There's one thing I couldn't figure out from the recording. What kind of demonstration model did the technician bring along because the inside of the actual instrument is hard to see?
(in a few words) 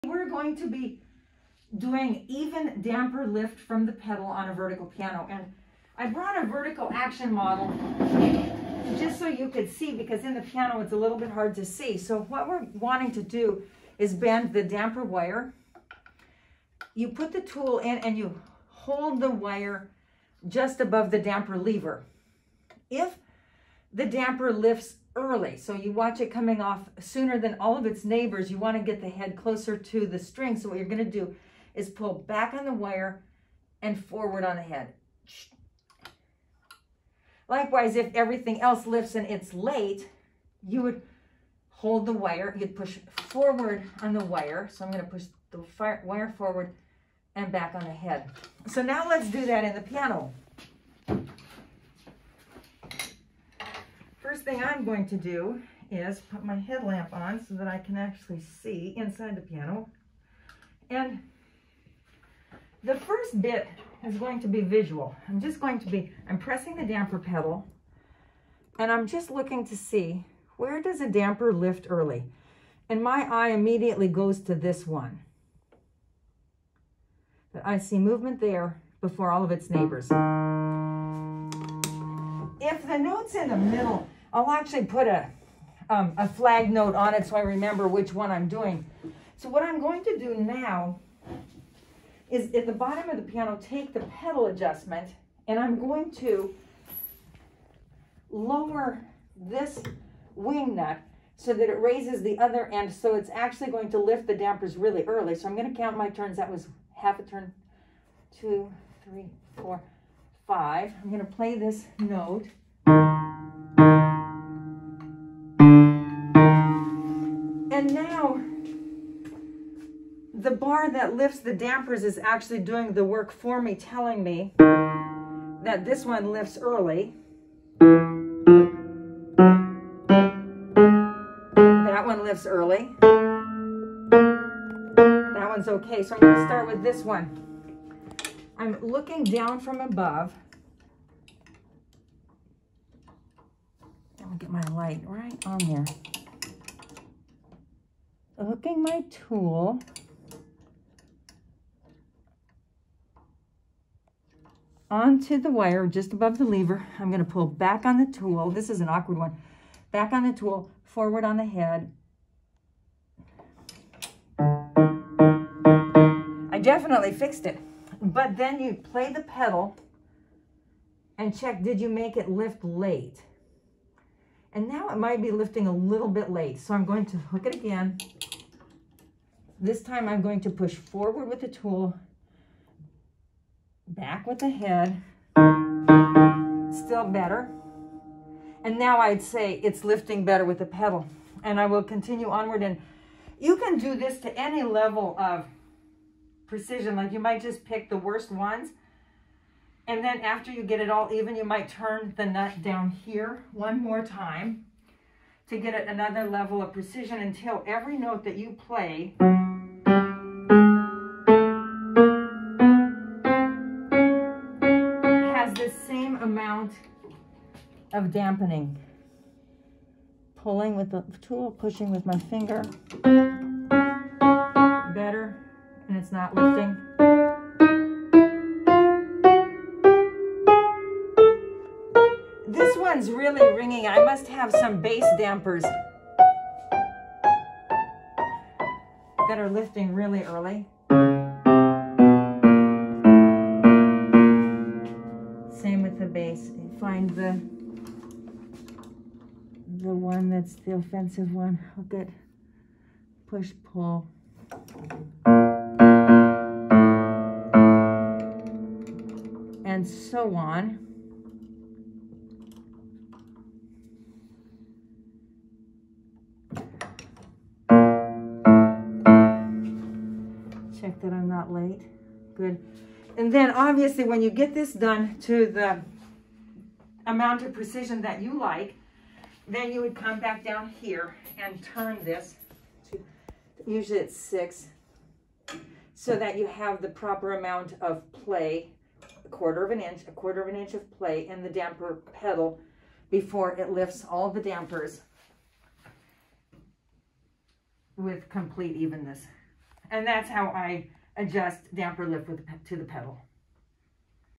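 vertical action model.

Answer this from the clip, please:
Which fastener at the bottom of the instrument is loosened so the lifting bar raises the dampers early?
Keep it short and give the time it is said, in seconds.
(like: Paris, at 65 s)
wing nut, at 100 s.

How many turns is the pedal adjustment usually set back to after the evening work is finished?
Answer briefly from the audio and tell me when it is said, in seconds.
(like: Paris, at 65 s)
6, at 284 s.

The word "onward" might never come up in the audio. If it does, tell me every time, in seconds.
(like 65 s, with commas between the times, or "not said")
192 s.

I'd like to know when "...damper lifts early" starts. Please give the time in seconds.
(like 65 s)
24 s.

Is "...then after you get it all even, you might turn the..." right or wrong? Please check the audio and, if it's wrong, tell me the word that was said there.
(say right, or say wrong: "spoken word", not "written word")
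right.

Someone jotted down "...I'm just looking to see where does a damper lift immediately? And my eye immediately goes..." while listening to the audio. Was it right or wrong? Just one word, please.
wrong.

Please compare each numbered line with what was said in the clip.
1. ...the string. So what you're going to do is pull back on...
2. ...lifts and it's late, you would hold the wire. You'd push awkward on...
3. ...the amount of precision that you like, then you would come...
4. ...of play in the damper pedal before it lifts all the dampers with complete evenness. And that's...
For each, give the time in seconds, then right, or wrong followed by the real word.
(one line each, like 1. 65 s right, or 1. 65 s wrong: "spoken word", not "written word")
1. 30 s right
2. 38 s wrong: "forward", not "awkward"
3. 275 s right
4. 290 s right.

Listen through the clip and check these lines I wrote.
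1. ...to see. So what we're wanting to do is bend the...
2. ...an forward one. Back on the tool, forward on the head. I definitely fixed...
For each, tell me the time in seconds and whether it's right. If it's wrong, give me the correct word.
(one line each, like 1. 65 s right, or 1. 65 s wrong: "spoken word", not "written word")
1. 11 s right
2. 158 s wrong: "awkward", not "forward".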